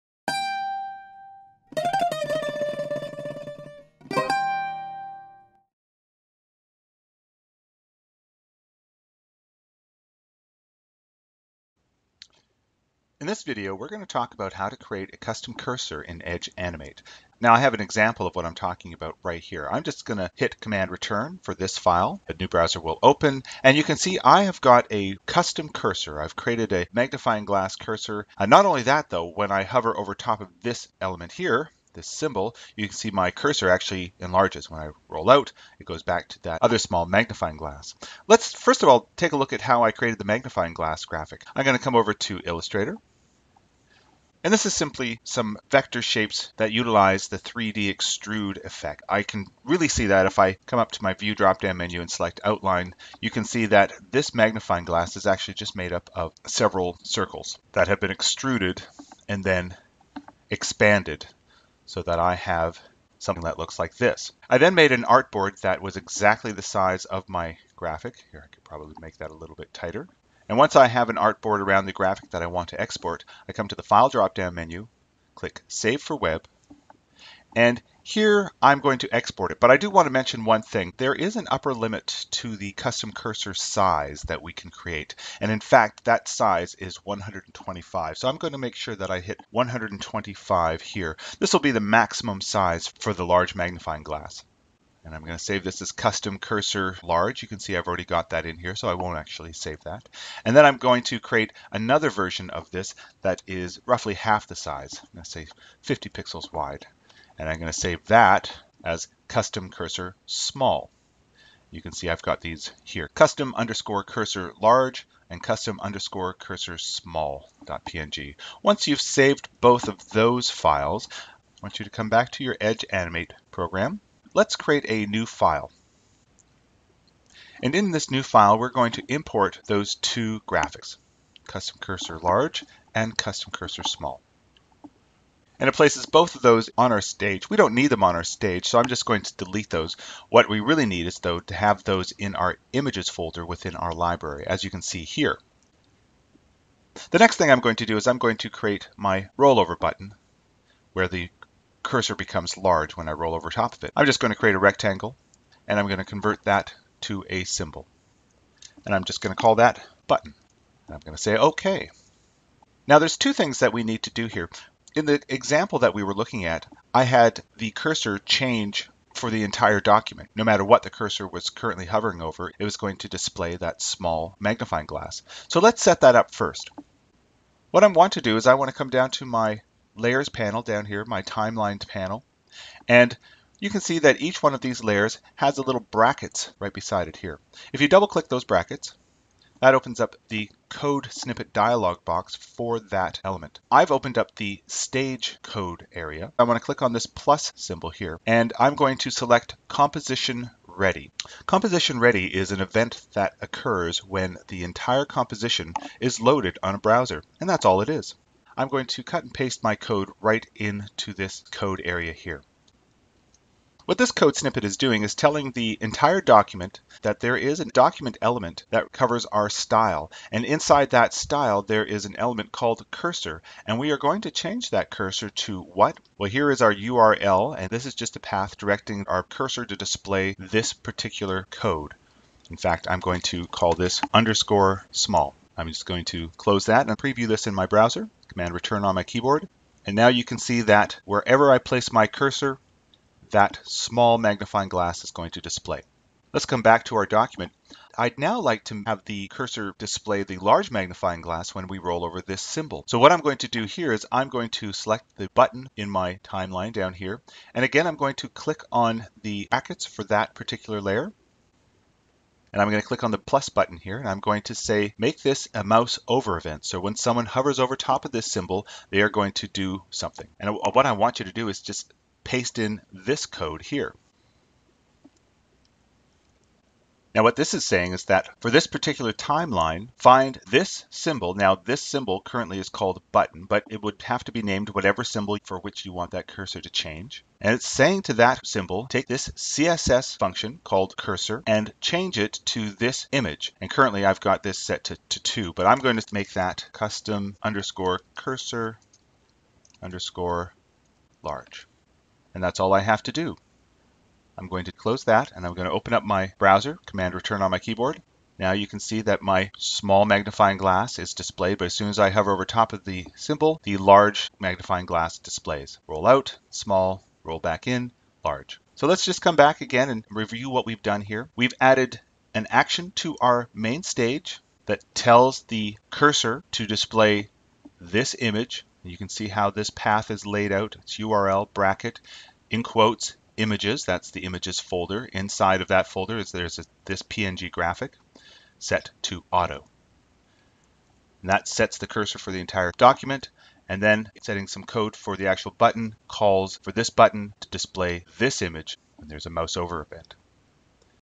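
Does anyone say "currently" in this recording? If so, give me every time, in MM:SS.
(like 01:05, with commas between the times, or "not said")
02:51, 04:42, 04:53.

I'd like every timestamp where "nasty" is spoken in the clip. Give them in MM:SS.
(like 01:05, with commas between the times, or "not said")
not said.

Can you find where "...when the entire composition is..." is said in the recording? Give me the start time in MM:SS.
03:23.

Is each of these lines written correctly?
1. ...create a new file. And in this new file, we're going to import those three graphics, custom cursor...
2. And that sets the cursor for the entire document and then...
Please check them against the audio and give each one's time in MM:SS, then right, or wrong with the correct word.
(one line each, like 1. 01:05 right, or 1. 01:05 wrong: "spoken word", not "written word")
1. 02:04 wrong: "two", not "three"
2. 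05:41 right.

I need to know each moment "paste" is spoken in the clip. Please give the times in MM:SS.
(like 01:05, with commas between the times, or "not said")
03:29, 04:32.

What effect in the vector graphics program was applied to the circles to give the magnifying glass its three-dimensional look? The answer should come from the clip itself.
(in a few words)
3D extrude.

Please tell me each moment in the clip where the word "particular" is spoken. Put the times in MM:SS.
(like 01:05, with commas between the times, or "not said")
03:50, 04:20, 04:38.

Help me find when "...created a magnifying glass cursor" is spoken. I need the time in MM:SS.
00:26.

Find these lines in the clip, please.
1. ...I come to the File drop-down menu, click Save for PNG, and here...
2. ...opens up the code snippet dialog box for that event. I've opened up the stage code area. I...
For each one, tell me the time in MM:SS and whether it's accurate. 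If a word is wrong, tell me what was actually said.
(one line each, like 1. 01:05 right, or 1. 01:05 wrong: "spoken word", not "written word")
1. 01:13 wrong: "Web", not "PNG"
2. 03:09 wrong: "element", not "event".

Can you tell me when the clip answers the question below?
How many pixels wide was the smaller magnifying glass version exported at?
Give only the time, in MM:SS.
01:45.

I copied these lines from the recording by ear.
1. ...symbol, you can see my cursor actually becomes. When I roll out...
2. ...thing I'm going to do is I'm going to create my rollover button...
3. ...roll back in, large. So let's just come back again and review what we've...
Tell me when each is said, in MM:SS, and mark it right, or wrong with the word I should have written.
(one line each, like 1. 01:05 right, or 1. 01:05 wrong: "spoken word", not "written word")
1. 00:32 wrong: "enlarges", not "becomes"
2. 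02:27 right
3. 05:17 right.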